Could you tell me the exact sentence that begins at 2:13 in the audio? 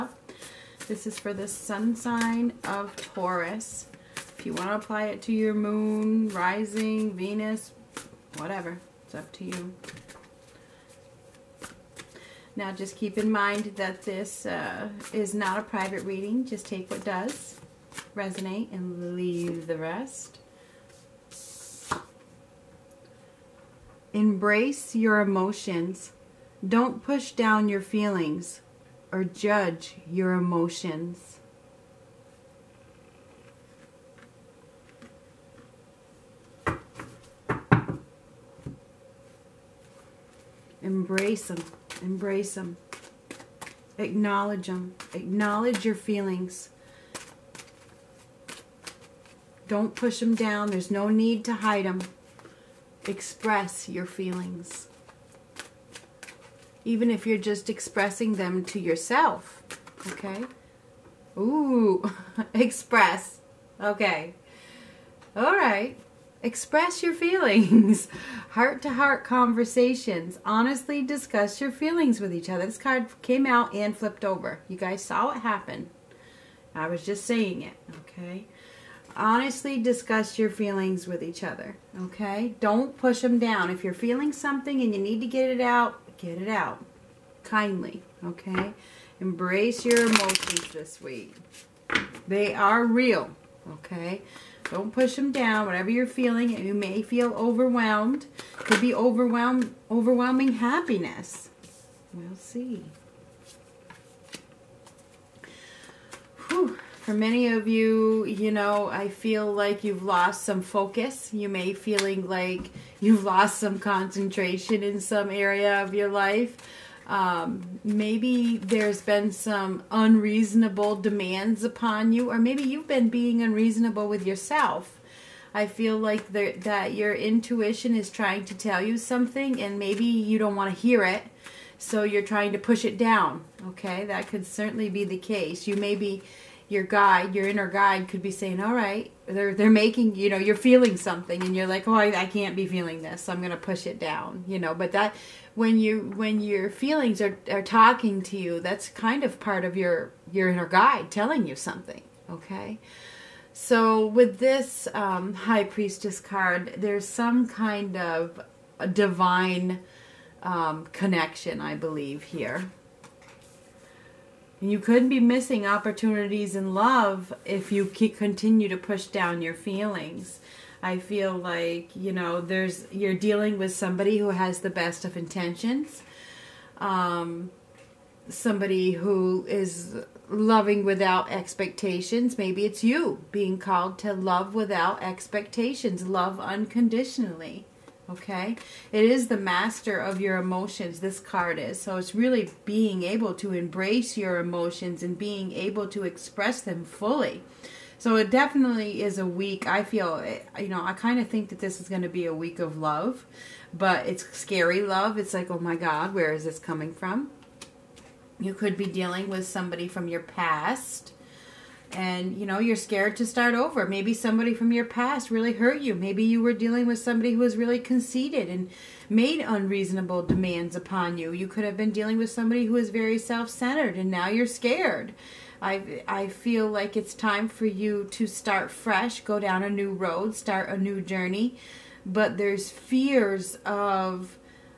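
Okay, that could certainly be the case.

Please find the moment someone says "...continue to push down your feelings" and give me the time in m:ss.
2:47.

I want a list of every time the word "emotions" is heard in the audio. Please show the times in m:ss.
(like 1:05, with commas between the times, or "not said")
0:25, 0:30, 1:30, 3:10, 3:14.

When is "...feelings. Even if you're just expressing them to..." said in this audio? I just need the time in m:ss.
0:54.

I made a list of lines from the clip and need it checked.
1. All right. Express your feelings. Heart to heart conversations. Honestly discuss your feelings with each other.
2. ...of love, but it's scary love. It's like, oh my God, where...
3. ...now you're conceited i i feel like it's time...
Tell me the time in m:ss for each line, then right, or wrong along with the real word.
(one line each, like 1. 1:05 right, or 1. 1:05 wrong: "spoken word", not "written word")
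1. 1:05 right
2. 3:22 right
3. 3:44 wrong: "scared", not "conceited".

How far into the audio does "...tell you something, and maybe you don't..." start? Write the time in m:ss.
2:08.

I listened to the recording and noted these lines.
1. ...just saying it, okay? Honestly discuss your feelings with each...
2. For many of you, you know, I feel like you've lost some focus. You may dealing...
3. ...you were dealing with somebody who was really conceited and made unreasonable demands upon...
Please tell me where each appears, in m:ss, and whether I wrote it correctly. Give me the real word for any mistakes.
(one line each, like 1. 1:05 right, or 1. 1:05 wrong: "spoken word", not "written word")
1. 1:17 right
2. 1:47 wrong: "feeling", not "dealing"
3. 3:36 right.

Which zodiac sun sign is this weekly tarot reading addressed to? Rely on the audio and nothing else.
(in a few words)
Taurus.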